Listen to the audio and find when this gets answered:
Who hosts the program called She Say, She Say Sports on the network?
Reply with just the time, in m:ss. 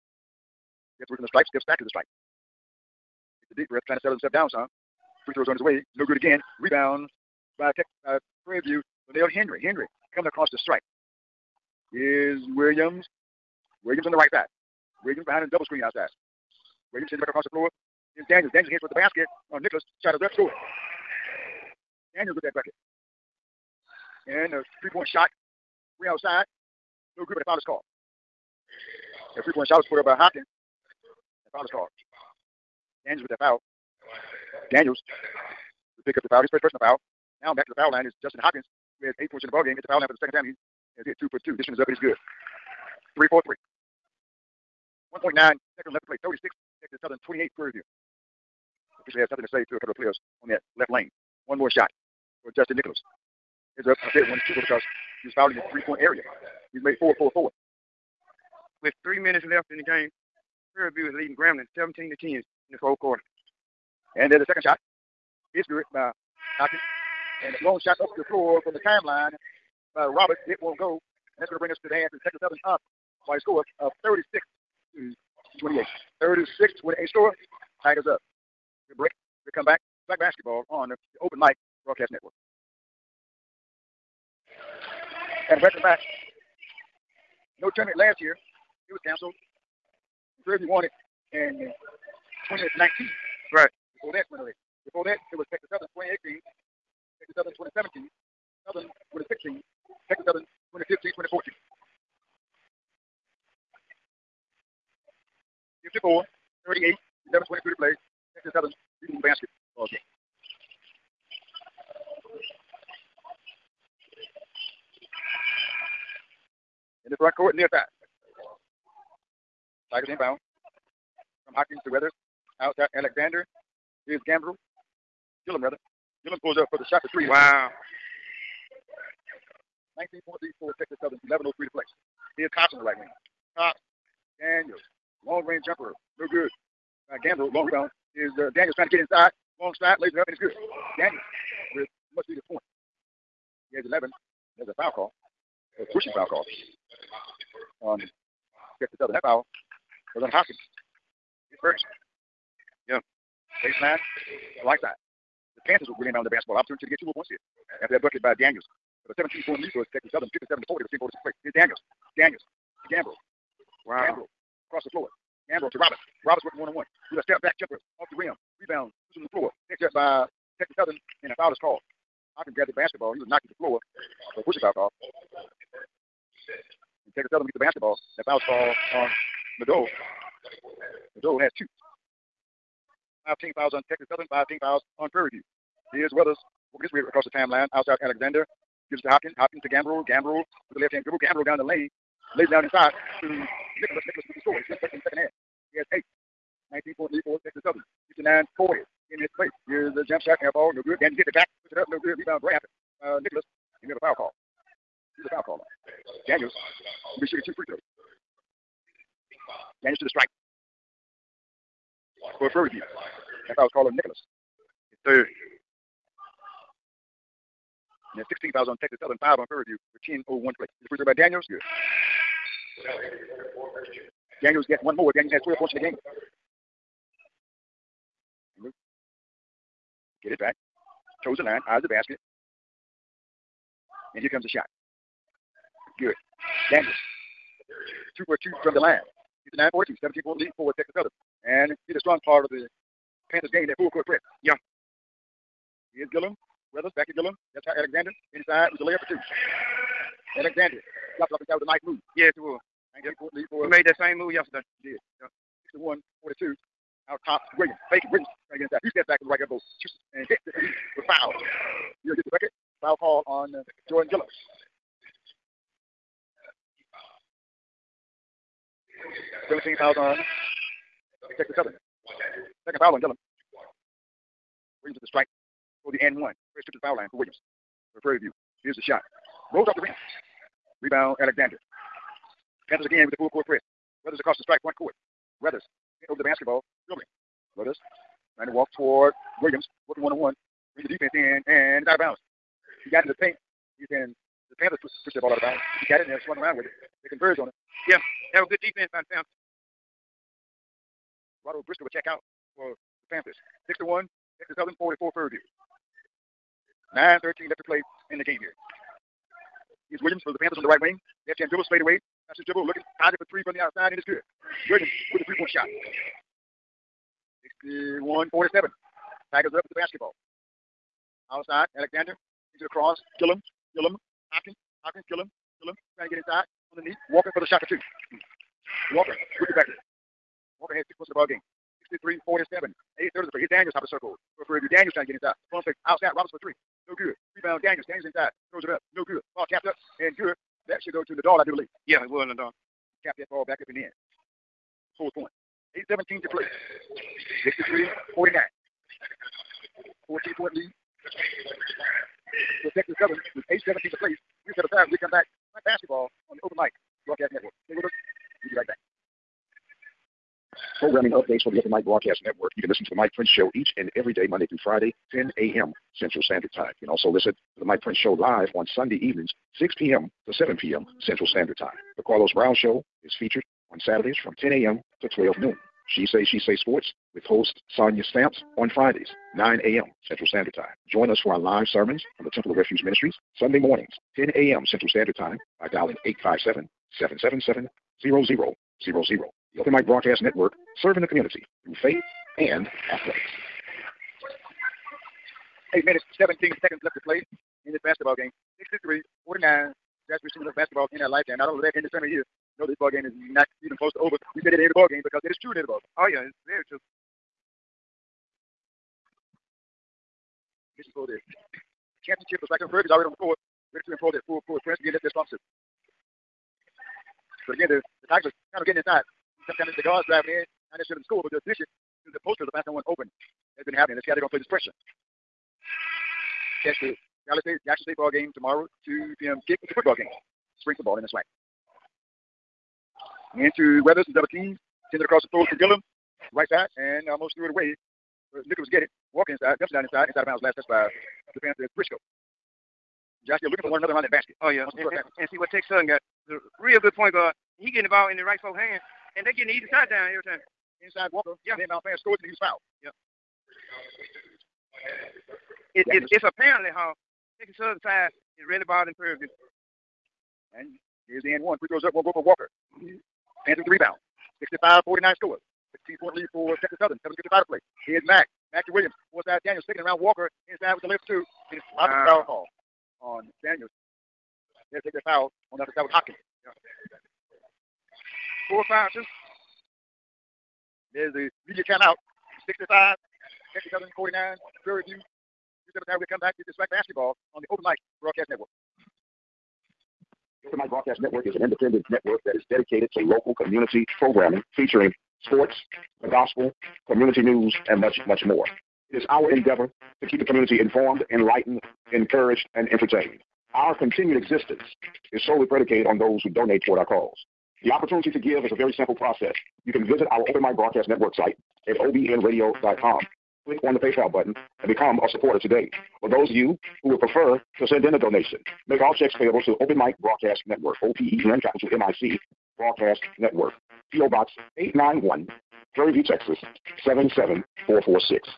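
6:17.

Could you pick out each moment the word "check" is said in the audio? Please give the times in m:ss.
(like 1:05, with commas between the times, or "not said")
5:01, 8:38.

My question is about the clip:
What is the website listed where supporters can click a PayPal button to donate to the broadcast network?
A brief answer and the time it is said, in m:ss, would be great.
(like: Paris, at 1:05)
obnradio.com, at 8:31.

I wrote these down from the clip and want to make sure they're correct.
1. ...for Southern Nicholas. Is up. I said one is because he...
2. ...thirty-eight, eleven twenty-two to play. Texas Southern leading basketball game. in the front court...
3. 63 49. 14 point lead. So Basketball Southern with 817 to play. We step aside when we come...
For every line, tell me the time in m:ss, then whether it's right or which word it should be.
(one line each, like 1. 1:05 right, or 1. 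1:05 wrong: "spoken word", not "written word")
1. 0:52 wrong: "Justin", not "Southern"
2. 1:46 right
3. 5:47 wrong: "Texas", not "Basketball".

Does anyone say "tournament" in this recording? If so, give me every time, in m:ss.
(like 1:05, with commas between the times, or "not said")
1:27, 6:41.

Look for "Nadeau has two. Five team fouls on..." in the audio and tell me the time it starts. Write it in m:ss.
3:01.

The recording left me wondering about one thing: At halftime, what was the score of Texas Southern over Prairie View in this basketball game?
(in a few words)
36 to 28.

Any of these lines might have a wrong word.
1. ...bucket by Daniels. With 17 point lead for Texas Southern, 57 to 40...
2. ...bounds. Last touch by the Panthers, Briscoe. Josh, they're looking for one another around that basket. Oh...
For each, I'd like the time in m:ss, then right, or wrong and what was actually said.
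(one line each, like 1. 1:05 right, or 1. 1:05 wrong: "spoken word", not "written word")
1. 2:38 right
2. 7:20 right.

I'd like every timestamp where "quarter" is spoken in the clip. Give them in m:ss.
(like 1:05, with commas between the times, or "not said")
1:03.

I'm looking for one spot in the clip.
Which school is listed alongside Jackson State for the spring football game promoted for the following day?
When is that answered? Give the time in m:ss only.
7:07.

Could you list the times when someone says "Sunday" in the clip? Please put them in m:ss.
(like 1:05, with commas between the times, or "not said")
6:08, 6:23.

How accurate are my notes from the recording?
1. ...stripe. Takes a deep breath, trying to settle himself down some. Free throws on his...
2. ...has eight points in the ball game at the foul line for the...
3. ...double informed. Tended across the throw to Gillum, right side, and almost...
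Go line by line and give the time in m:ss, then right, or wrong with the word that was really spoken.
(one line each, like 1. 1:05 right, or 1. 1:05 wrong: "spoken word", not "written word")
1. 0:01 right
2. 0:39 right
3. 7:14 wrong: "teamed", not "informed".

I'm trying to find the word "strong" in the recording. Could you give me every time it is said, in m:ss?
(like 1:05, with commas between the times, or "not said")
4:01, 6:55.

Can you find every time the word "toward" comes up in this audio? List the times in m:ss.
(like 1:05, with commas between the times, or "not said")
0:18, 4:48, 8:26.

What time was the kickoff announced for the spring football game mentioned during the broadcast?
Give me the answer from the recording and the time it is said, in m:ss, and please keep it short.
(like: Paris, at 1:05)
2 p.m., at 7:08.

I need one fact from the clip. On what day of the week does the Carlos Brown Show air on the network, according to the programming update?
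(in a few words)
Saturdays.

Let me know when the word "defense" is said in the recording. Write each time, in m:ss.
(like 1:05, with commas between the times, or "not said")
4:50, 4:58.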